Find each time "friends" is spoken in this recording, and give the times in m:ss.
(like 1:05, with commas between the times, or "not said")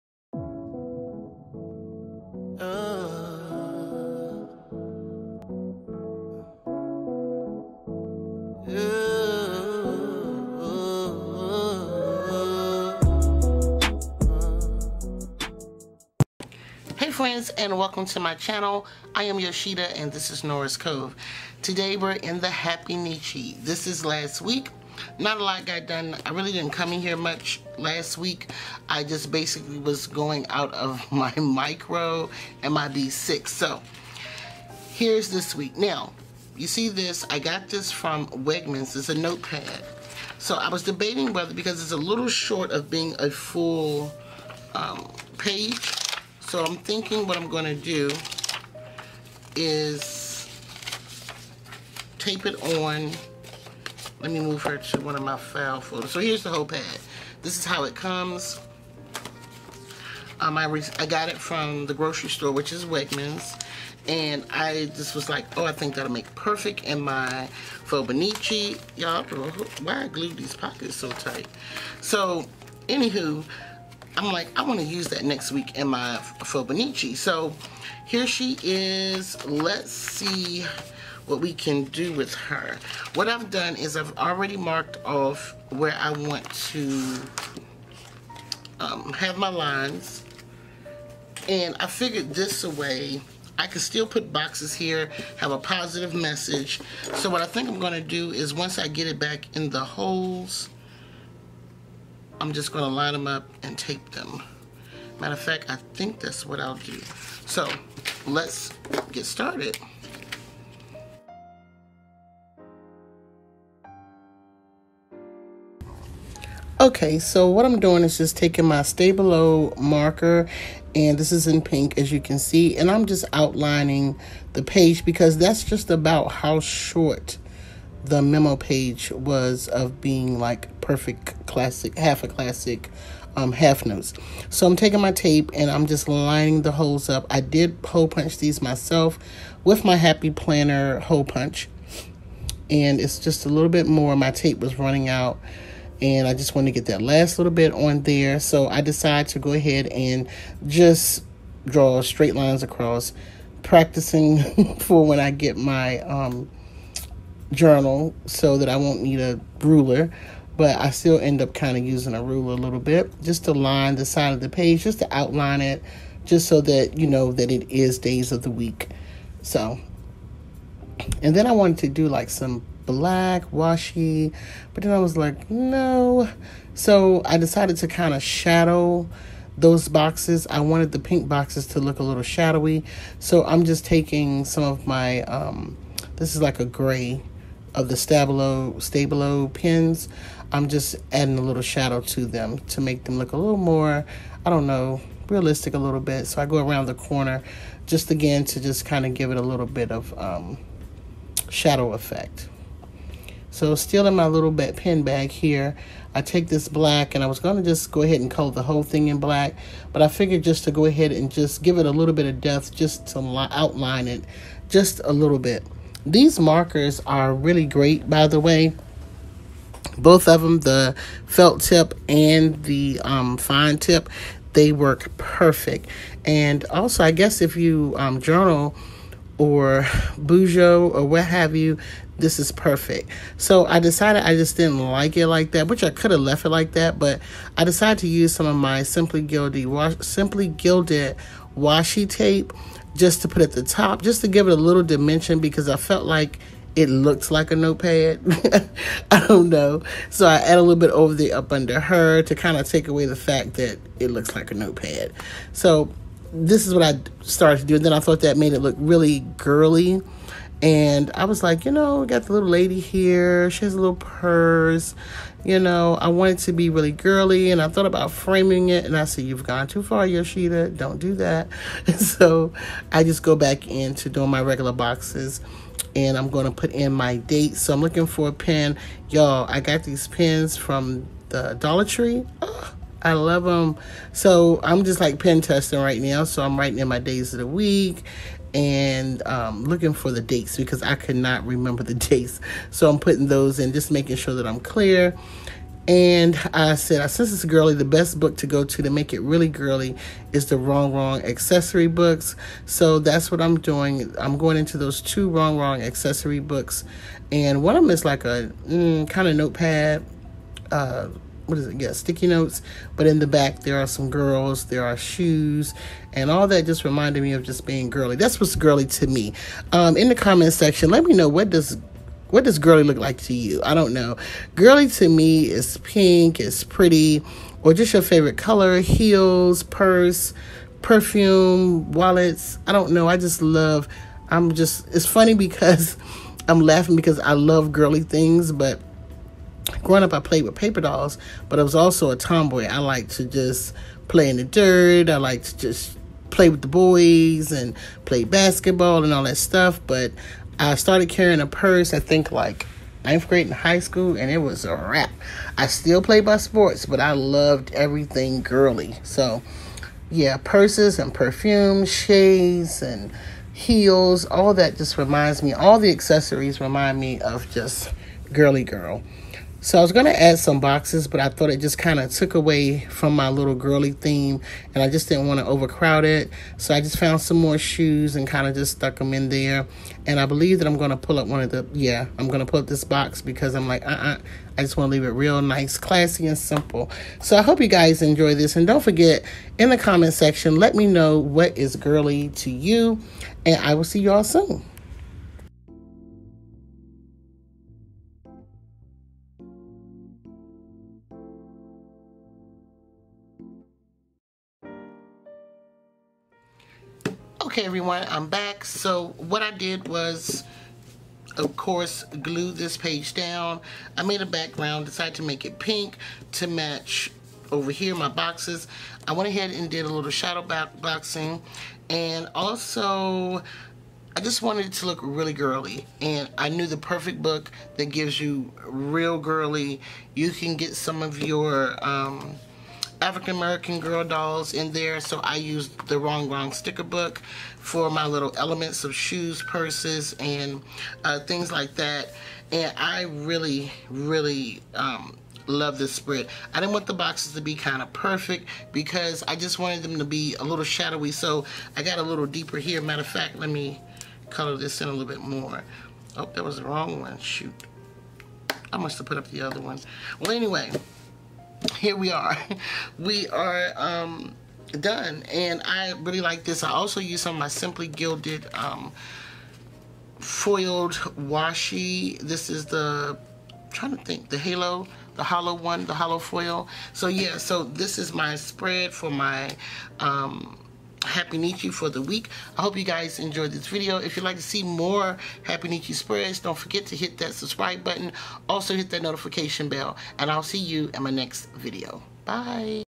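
0:17.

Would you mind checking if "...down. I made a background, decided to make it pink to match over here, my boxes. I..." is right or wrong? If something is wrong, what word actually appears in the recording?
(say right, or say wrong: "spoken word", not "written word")
right.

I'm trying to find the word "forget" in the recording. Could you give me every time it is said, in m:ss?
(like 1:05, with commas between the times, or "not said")
6:28, 8:06.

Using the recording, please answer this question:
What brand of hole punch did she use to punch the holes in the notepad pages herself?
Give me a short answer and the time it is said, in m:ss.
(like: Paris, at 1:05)
Happy Planner, at 2:19.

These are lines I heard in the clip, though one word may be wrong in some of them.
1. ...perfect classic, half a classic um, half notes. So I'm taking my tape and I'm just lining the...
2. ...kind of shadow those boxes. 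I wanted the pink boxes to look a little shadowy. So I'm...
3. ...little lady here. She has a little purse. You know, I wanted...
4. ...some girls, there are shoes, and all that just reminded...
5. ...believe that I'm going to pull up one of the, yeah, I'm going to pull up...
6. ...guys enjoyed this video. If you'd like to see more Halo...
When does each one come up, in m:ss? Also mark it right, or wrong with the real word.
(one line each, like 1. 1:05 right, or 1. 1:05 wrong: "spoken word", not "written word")
1. 2:10 right
2. 2:57 right
3. 4:22 right
4. 5:13 right
5. 6:20 right
6. 8:02 wrong: "Happynichi", not "Halo".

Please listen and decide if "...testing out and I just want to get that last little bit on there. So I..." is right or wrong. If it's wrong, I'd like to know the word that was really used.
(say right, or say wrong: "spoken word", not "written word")
wrong: "running", not "testing".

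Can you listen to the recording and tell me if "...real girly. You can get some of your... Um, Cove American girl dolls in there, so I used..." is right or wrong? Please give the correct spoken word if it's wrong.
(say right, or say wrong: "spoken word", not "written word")
wrong: "African", not "Cove".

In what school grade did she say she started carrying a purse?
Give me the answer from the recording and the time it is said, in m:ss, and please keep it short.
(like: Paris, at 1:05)
ninth grade, at 5:53.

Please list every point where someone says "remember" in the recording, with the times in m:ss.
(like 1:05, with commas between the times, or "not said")
4:51.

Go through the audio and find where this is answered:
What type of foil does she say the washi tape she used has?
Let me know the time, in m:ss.
7:55.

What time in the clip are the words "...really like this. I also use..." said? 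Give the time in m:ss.
7:45.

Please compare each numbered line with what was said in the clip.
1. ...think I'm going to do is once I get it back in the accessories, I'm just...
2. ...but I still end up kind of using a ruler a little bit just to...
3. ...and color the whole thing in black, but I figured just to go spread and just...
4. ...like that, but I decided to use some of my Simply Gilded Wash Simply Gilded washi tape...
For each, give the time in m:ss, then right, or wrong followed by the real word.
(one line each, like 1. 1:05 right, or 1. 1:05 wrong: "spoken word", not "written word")
1. 1:37 wrong: "holes", not "accessories"
2. 2:40 right
3. 3:28 wrong: "ahead", not "spread"
4. 3:56 right.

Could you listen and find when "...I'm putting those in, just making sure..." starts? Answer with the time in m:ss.
4:52.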